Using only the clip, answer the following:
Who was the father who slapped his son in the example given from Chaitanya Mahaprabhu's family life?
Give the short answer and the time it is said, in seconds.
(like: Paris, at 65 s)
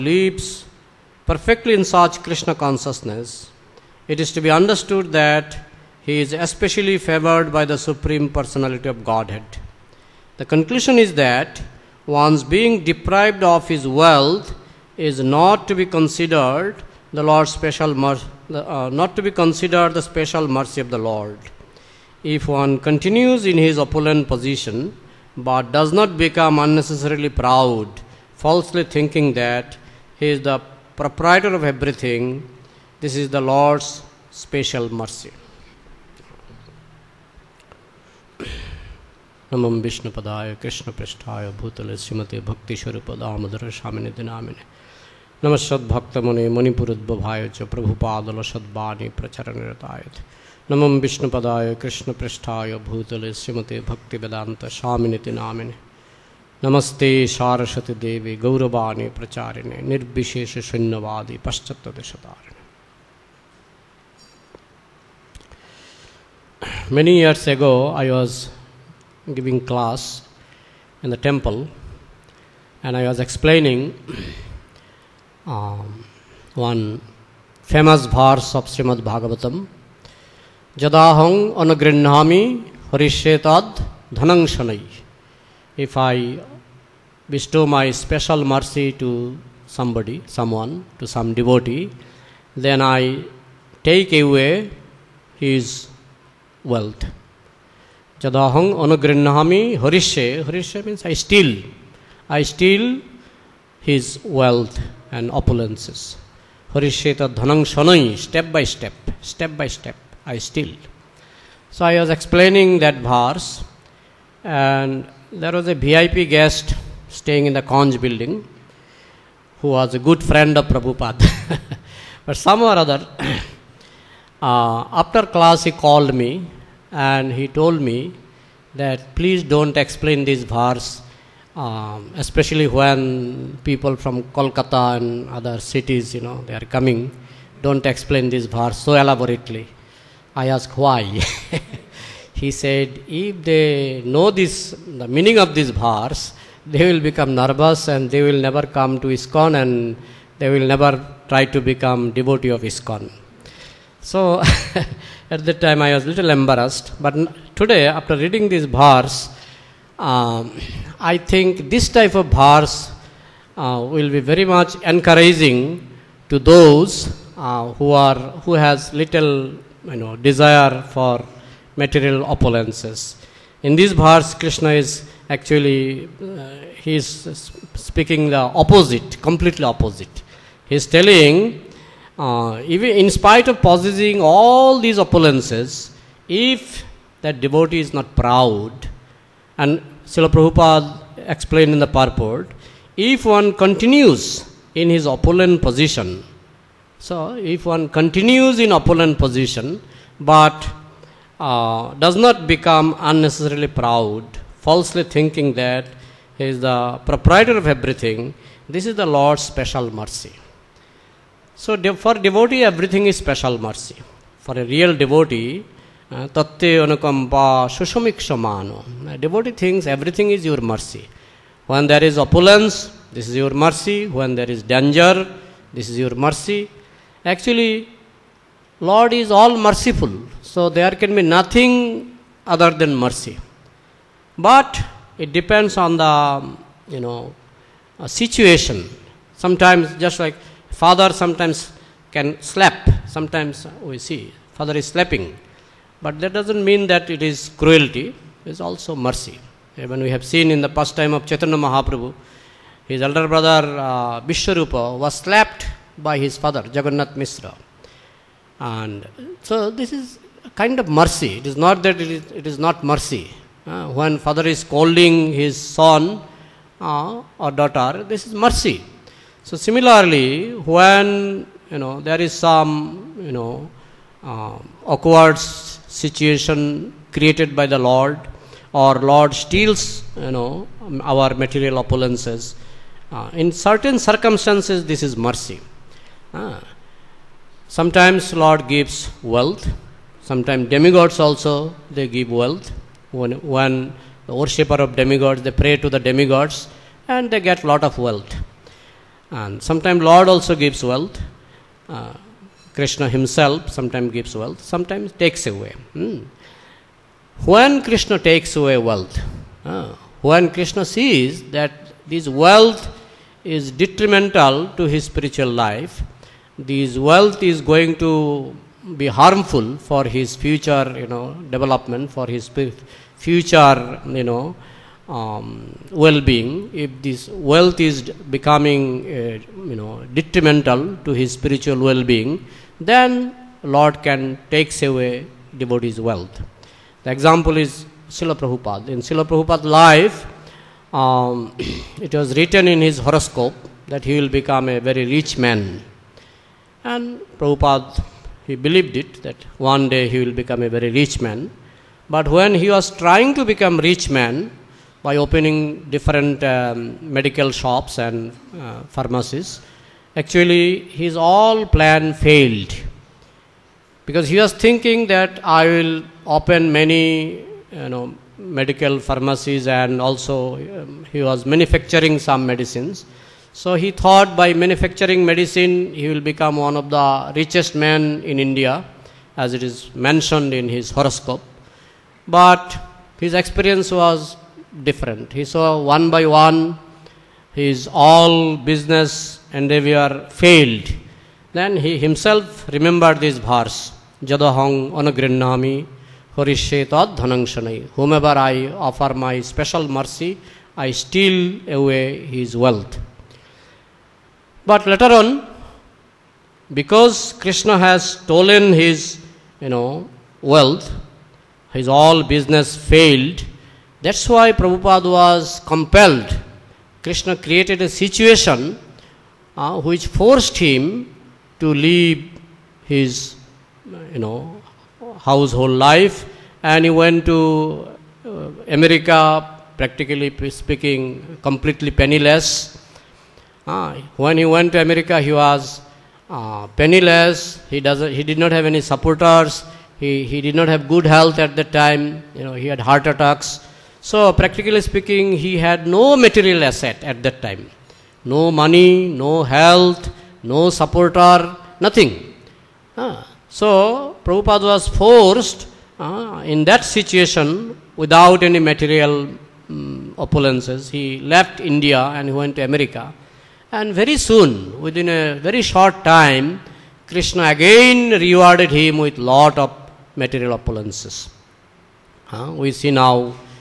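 Jagannath Misra, at 256 s.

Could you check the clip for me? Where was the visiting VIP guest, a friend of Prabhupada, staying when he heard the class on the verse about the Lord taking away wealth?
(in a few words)
Conch building.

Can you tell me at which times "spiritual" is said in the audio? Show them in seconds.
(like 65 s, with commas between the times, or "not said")
315 s, 331 s.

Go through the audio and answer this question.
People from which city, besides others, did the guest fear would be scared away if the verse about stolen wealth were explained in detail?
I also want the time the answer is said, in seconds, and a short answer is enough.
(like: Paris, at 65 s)
Kolkata, at 134 s.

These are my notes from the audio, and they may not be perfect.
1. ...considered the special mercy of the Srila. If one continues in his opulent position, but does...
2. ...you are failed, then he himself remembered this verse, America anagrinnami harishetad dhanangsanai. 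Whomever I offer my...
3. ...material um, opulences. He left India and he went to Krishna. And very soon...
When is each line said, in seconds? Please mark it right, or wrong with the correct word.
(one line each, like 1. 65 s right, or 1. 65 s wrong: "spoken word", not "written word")
1. 19 s wrong: "Lord", not "Srila"
2. 389 s wrong: "Jadahang", not "America"
3. 458 s wrong: "America", not "Krishna".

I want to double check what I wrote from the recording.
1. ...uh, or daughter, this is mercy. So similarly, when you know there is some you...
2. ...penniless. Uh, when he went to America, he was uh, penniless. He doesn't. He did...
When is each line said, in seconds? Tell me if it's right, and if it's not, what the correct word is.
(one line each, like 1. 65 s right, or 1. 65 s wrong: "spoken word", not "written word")
1. 266 s right
2. 431 s right.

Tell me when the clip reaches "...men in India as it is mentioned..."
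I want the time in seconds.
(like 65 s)
377 s.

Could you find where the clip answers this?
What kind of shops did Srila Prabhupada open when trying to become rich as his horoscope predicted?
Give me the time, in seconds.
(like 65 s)
357 s.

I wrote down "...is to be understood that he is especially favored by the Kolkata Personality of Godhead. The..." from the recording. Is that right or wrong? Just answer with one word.
wrong.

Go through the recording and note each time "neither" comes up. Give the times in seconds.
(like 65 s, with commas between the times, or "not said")
not said.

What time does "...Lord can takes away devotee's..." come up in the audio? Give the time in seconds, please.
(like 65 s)
333 s.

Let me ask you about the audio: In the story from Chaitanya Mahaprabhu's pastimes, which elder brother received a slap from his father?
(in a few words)
Vishwarupa.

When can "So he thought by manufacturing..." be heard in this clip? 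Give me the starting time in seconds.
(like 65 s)
373 s.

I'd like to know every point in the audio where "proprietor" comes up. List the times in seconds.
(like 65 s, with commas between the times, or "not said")
30 s, 207 s.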